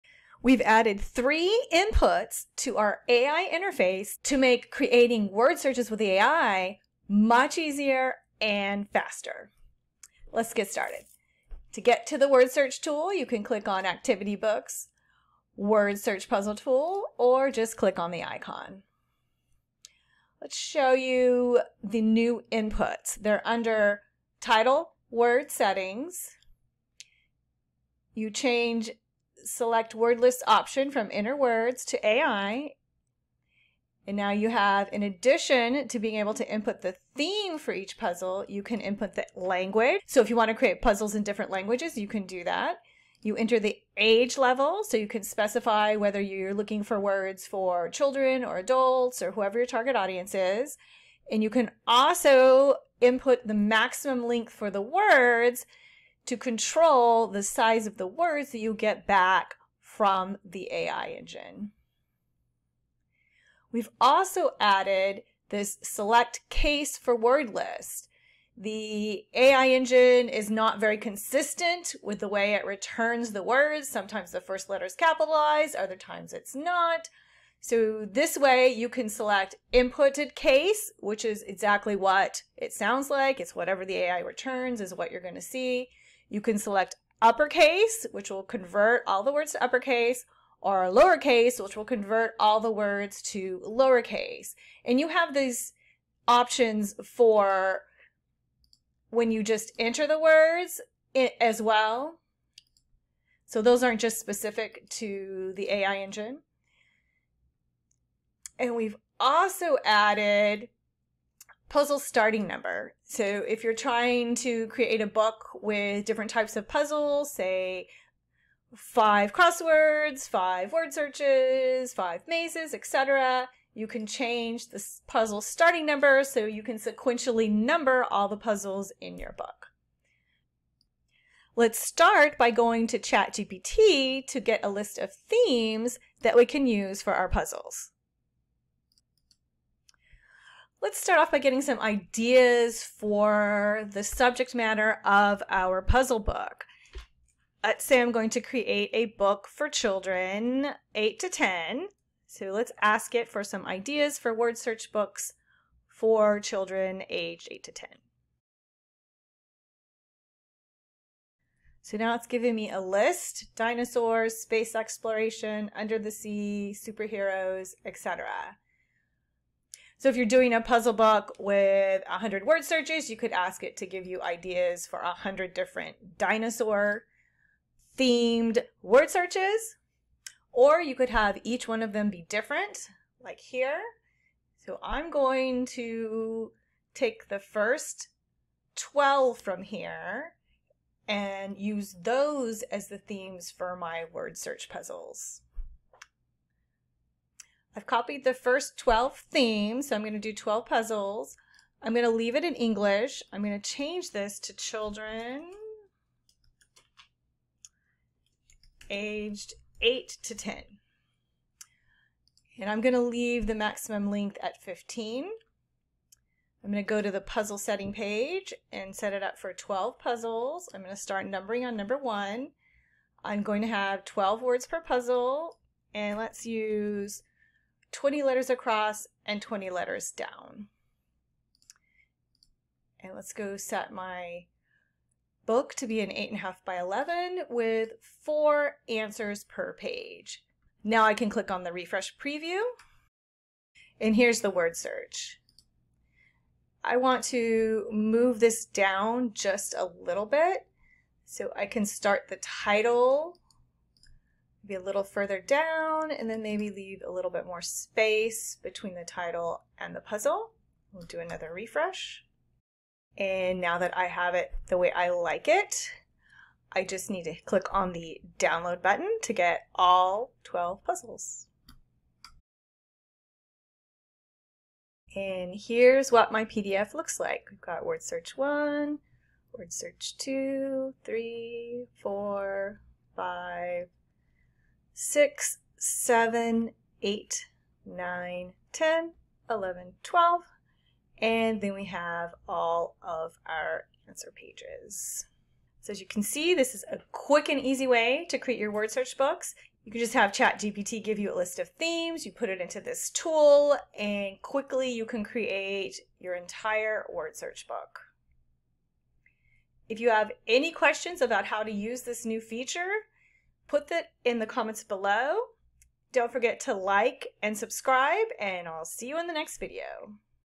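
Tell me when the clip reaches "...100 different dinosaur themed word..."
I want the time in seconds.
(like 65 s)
174 s.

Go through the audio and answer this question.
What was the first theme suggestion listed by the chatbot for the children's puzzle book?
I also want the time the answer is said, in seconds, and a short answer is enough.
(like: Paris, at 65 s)
dinosaurs, at 163 s.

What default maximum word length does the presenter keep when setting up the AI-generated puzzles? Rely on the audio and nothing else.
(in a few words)
15.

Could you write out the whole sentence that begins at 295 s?
So as you can see, this is a quick and easy way to create your word search books.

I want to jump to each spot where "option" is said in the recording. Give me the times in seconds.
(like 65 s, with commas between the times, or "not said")
30 s, 96 s.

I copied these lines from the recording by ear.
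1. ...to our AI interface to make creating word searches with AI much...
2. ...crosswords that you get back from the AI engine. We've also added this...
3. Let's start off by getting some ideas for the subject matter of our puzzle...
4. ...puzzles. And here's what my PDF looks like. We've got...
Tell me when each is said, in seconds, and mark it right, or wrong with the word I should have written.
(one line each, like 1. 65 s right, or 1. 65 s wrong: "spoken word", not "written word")
1. 2 s right
2. 58 s wrong: "words", not "crosswords"
3. 140 s right
4. 270 s right.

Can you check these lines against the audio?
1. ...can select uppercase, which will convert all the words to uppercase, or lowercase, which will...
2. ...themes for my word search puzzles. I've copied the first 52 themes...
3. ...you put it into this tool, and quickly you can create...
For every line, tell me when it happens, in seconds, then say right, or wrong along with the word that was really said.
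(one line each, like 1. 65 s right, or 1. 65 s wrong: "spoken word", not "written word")
1. 86 s right
2. 192 s wrong: "12", not "52"
3. 302 s right.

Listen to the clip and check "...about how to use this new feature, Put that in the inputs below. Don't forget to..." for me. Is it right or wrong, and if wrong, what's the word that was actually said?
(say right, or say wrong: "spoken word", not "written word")
wrong: "comments", not "inputs".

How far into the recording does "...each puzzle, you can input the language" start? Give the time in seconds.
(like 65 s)
37 s.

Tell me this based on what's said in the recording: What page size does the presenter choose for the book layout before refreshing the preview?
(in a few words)
8.5 by 11.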